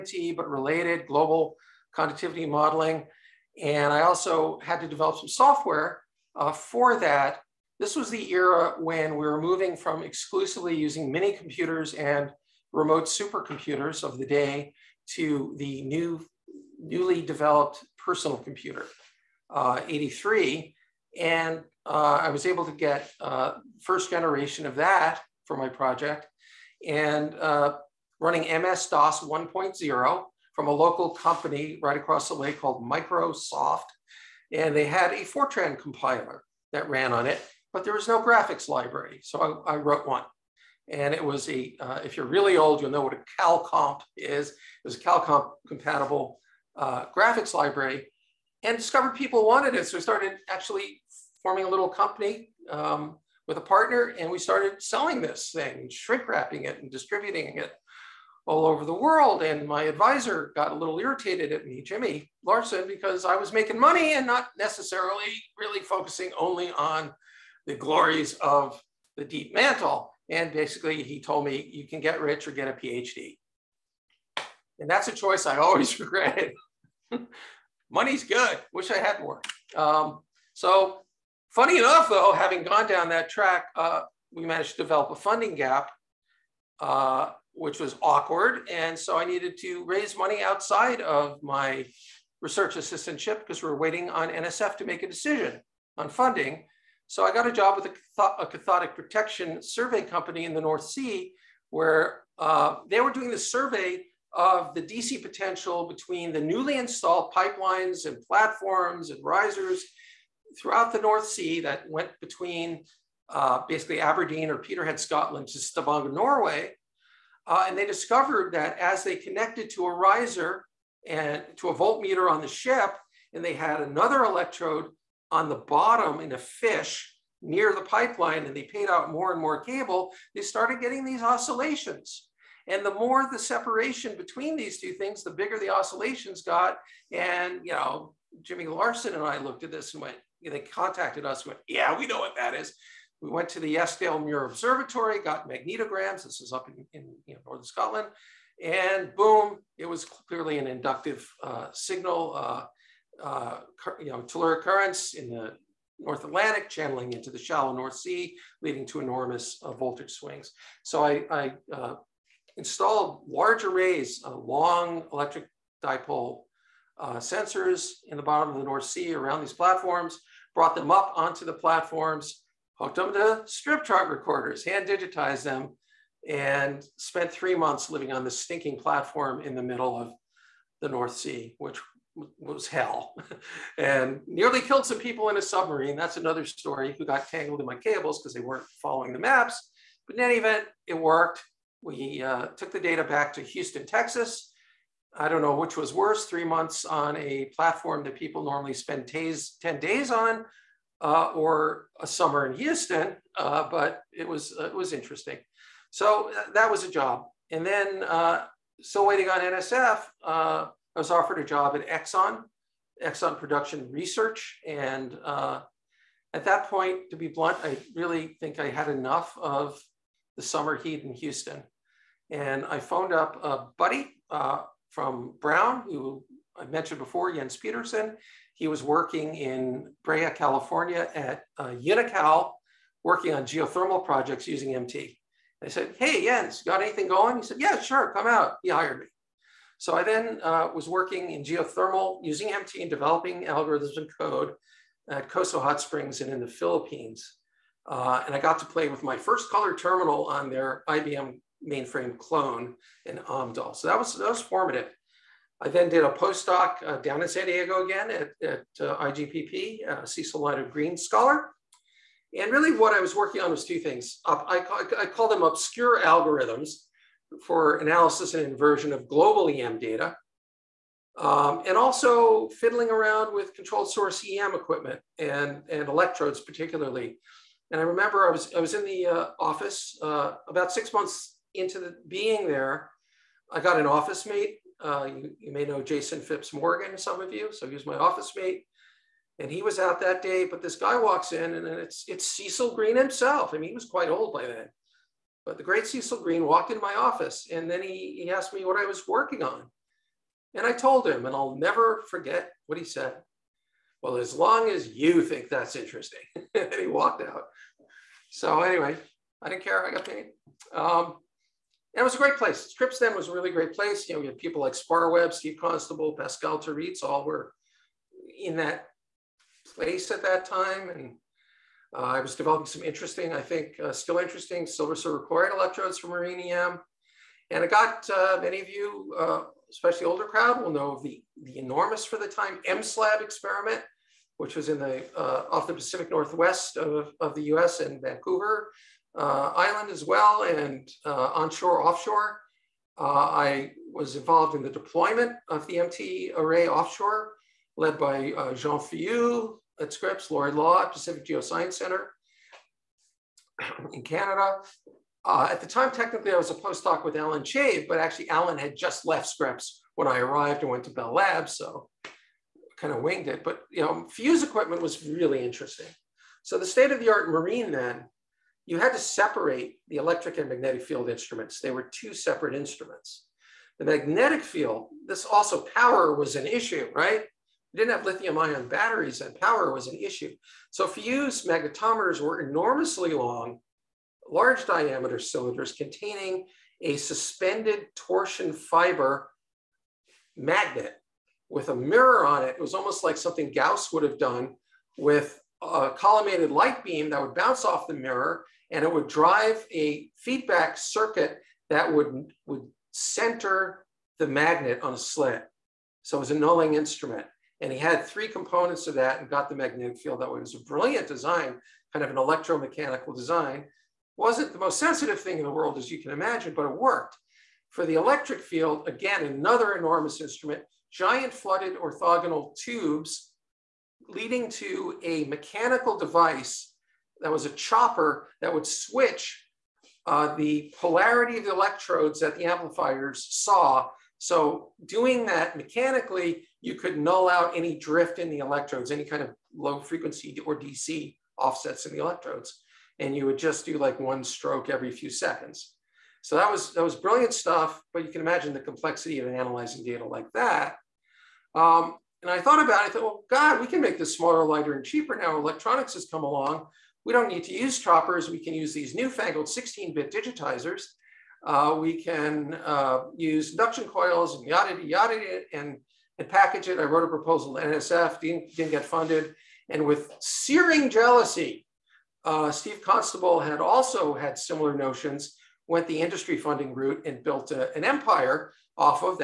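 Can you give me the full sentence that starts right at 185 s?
That's another story who got tangled in my cables because they weren't following the maps.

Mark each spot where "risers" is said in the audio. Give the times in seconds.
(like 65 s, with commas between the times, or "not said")
109 s, 119 s.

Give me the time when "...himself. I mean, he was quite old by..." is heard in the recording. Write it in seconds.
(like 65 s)
292 s.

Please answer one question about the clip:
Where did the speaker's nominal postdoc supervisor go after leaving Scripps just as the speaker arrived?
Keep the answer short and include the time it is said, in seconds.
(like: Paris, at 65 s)
Bell Labs, at 360 s.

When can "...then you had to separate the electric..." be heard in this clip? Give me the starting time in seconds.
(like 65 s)
367 s.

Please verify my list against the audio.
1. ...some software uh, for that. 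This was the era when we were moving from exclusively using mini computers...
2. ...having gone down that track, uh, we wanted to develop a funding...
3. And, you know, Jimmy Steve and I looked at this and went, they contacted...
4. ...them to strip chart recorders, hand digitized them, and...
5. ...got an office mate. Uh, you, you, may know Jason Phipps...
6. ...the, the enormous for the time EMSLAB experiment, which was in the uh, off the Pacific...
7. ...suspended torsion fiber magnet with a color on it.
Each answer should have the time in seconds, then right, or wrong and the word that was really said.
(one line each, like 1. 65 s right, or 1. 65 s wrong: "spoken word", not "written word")
1. 5 s right
2. 82 s wrong: "managed", not "wanted"
3. 137 s wrong: "Larsen", not "Steve"
4. 172 s right
5. 283 s right
6. 331 s right
7. 386 s wrong: "mirror", not "color".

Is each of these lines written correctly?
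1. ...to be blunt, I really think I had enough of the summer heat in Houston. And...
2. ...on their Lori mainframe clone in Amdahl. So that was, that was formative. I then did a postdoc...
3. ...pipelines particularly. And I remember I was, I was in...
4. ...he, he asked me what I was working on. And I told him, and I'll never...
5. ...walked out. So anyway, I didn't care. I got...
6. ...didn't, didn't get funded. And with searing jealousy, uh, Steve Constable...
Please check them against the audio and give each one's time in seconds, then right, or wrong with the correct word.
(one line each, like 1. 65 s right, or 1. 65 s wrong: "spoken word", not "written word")
1. 217 s right
2. 250 s wrong: "IBM", not "Lori"
3. 275 s wrong: "electrodes", not "pipelines"
4. 297 s right
5. 306 s right
6. 468 s right.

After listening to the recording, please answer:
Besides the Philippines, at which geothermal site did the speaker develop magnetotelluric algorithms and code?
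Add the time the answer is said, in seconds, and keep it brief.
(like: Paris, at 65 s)
Coso Hot Springs, at 245 s.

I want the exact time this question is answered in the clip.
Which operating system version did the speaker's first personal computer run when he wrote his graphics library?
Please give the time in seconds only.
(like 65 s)
28 s.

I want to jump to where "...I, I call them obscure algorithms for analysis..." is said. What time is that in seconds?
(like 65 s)
264 s.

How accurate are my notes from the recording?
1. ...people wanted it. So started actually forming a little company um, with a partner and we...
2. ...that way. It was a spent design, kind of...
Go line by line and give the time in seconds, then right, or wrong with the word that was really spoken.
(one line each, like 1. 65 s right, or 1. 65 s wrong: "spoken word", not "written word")
1. 49 s right
2. 410 s wrong: "brilliant", not "spent".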